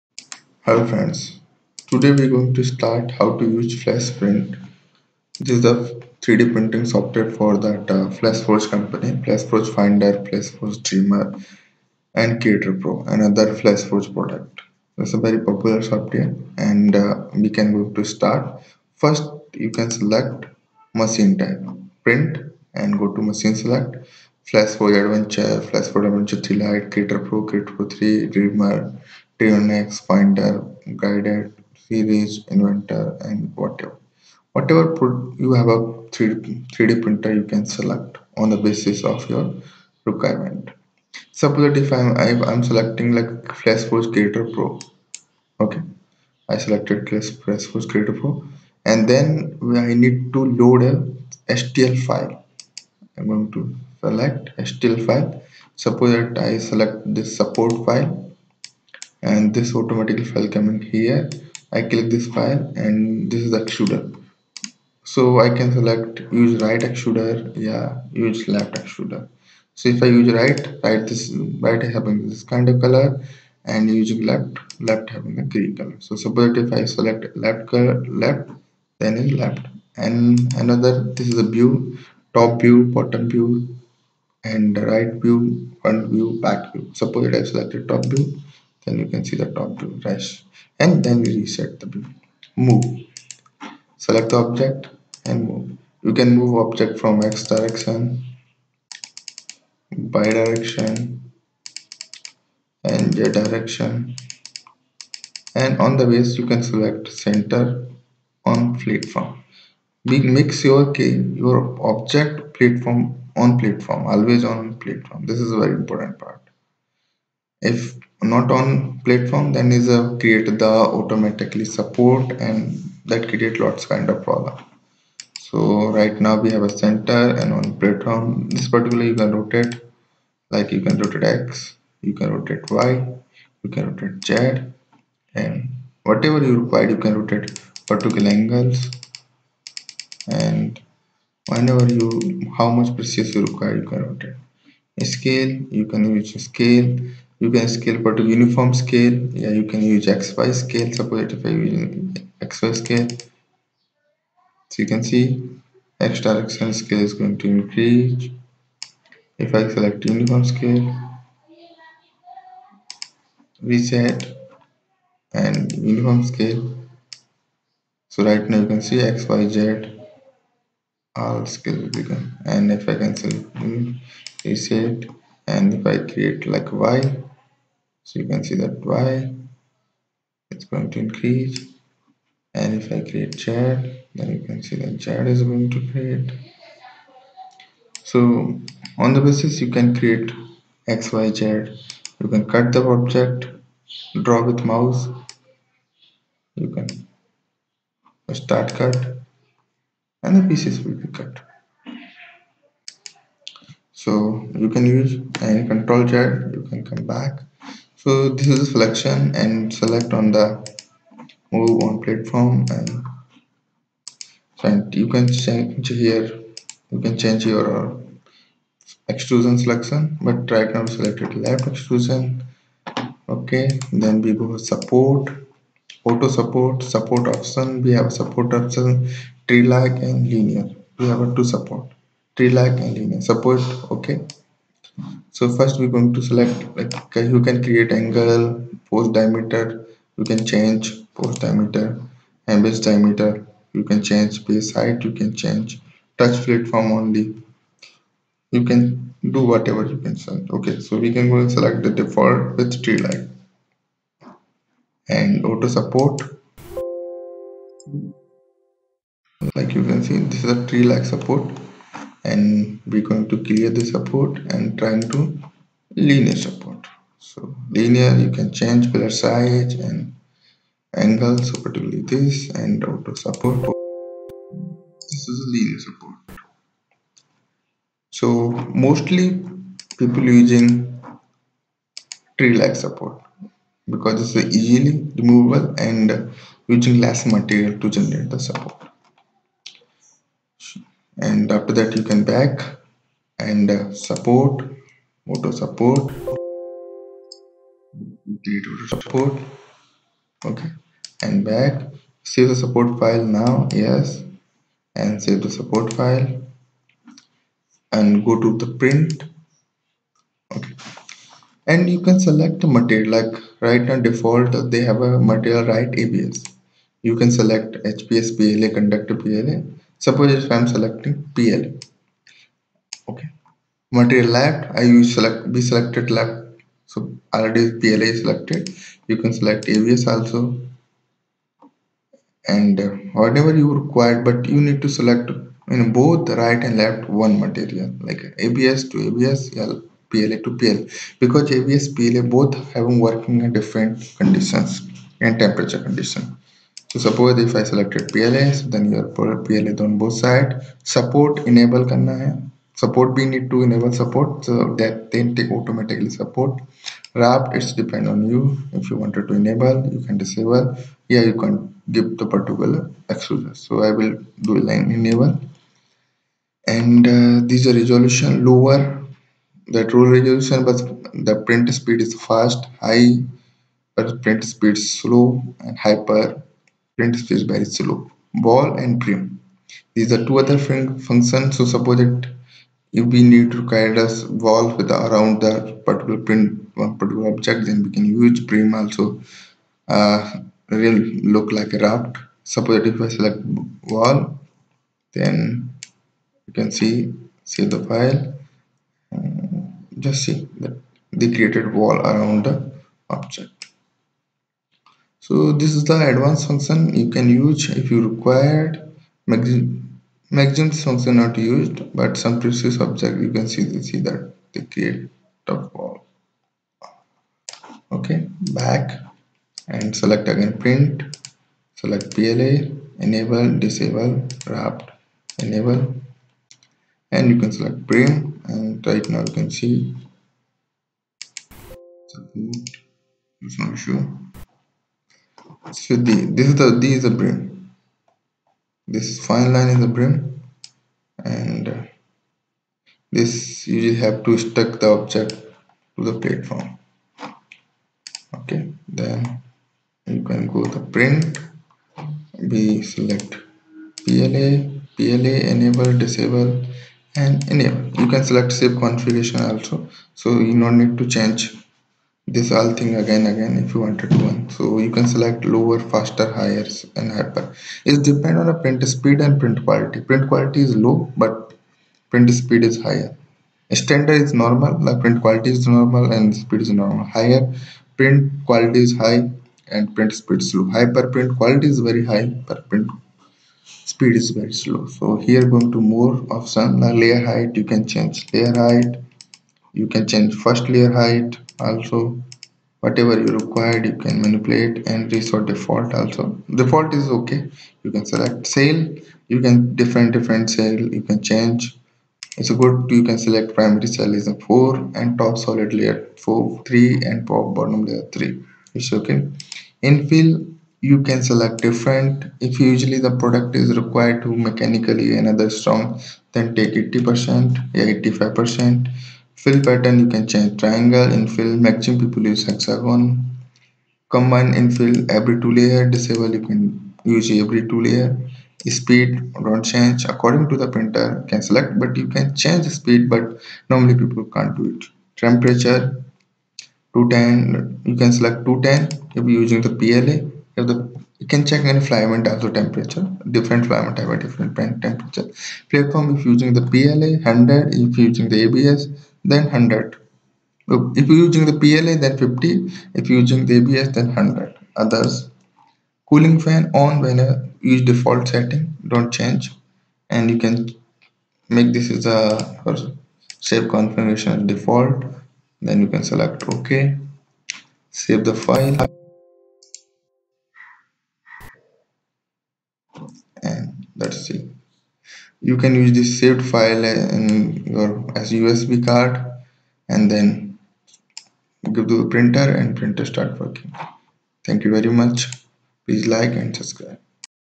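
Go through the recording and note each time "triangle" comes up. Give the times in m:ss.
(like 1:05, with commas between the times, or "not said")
8:40.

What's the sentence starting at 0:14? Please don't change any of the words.
It's a very popular software and uh, we can go to start.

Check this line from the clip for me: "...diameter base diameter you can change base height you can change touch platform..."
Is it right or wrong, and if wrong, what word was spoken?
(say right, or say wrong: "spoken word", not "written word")
right.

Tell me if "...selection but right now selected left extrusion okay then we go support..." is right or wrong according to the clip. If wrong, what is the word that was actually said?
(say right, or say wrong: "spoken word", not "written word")
right.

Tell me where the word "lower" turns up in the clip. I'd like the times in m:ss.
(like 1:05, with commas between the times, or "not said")
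6:08, 7:45.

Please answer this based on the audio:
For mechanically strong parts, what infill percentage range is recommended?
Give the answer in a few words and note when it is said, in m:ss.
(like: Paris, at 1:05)
80 to 85 percent, at 8:36.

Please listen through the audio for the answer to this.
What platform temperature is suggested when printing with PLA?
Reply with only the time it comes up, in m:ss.
9:12.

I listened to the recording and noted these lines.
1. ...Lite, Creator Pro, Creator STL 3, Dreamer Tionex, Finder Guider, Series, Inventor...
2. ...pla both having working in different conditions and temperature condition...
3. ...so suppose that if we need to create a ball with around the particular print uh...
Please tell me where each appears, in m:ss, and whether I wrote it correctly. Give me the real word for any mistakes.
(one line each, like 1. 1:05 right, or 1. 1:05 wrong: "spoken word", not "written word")
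1. 0:26 wrong: "Pro", not "STL"
2. 5:41 right
3. 6:21 right.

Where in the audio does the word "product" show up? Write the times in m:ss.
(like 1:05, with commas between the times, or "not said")
0:14, 8:33.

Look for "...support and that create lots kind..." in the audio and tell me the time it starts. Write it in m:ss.
2:01.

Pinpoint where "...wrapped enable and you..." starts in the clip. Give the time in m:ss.
7:04.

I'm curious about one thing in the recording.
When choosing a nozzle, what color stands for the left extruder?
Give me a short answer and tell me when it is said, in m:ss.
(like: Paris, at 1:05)
Green, at 1:15.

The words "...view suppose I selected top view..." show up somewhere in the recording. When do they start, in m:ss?
1:26.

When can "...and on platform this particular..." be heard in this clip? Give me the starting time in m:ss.
2:07.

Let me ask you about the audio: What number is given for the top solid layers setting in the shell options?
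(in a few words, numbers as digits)
4.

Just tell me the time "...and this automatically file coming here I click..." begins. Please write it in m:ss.
0:59.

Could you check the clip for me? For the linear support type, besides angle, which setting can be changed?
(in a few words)
Pillar size.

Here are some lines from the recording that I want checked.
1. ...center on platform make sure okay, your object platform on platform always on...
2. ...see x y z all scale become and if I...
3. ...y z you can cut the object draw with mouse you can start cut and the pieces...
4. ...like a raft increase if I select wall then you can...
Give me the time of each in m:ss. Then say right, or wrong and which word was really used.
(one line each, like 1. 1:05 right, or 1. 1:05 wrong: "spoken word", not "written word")
1. 1:47 right
2. 2:48 right
3. 3:11 right
4. 6:31 wrong: "suppose", not "increase".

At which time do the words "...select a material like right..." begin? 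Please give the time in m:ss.
5:12.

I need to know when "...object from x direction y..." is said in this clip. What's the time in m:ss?
1:36.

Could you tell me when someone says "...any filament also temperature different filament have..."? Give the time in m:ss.
9:01.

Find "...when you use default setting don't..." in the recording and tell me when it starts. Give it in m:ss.
9:17.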